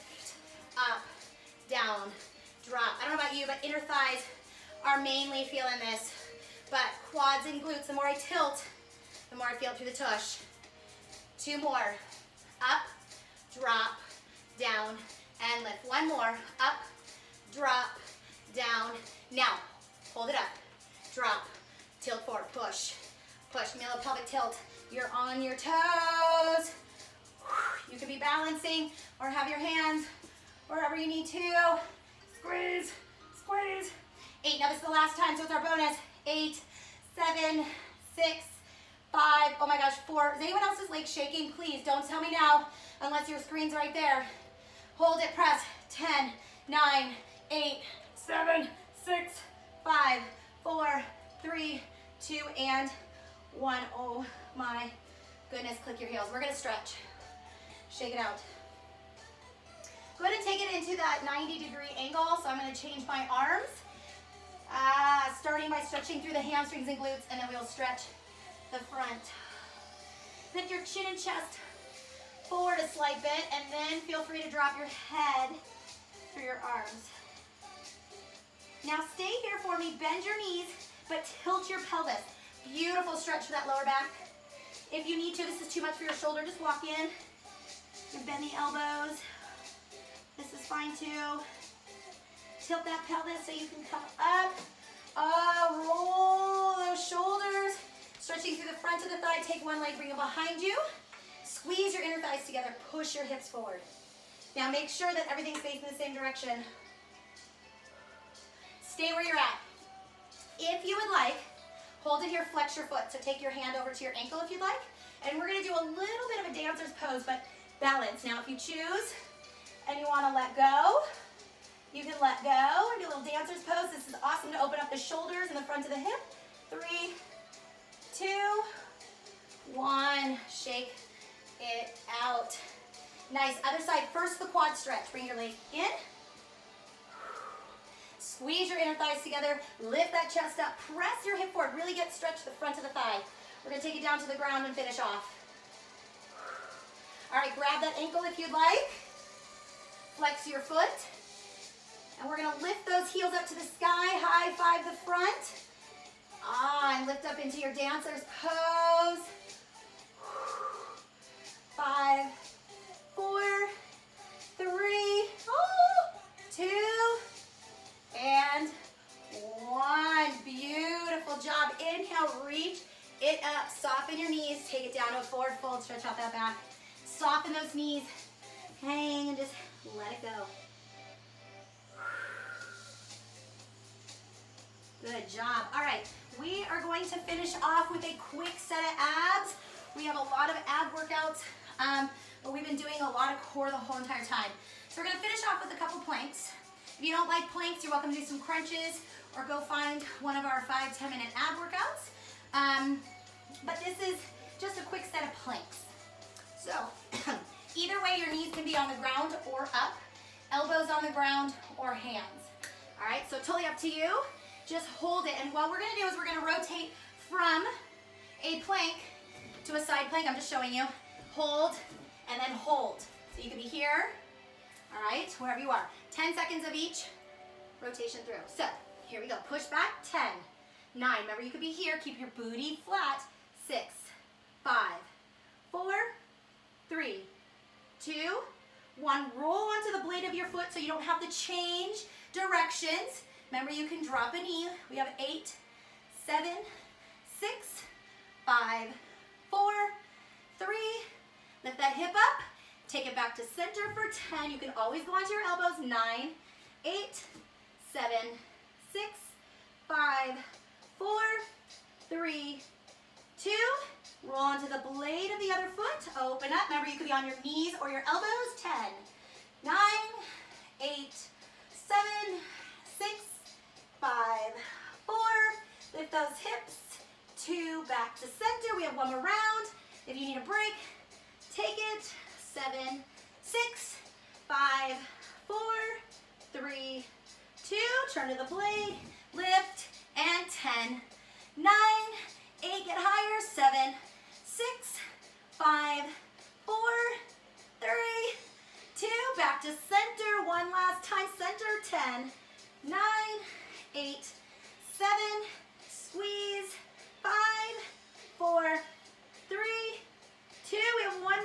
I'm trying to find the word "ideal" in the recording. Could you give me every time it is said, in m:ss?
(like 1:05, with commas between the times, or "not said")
not said.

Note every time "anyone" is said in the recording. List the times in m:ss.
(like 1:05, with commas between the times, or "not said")
0:40.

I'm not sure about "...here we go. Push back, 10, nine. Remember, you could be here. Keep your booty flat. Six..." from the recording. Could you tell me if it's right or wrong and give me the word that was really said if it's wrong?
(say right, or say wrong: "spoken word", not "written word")
right.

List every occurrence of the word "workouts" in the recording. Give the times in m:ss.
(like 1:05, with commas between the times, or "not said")
3:10, 3:21.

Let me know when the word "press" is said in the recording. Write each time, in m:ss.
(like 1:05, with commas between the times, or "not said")
0:45, 2:20.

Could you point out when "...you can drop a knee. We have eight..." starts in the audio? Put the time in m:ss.
4:03.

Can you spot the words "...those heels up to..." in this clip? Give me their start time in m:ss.
2:32.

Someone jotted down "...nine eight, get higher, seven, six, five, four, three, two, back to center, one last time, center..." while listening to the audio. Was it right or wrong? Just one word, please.
right.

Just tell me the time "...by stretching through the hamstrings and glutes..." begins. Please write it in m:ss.
1:05.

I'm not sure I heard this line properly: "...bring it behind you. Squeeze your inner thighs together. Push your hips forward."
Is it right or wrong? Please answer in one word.
right.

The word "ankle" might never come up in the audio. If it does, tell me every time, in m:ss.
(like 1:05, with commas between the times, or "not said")
1:54, 2:27.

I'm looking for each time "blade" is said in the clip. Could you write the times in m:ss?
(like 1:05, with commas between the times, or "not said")
4:00, 4:24, 4:48.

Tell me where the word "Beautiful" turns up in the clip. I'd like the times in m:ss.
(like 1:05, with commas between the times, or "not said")
1:22, 2:50.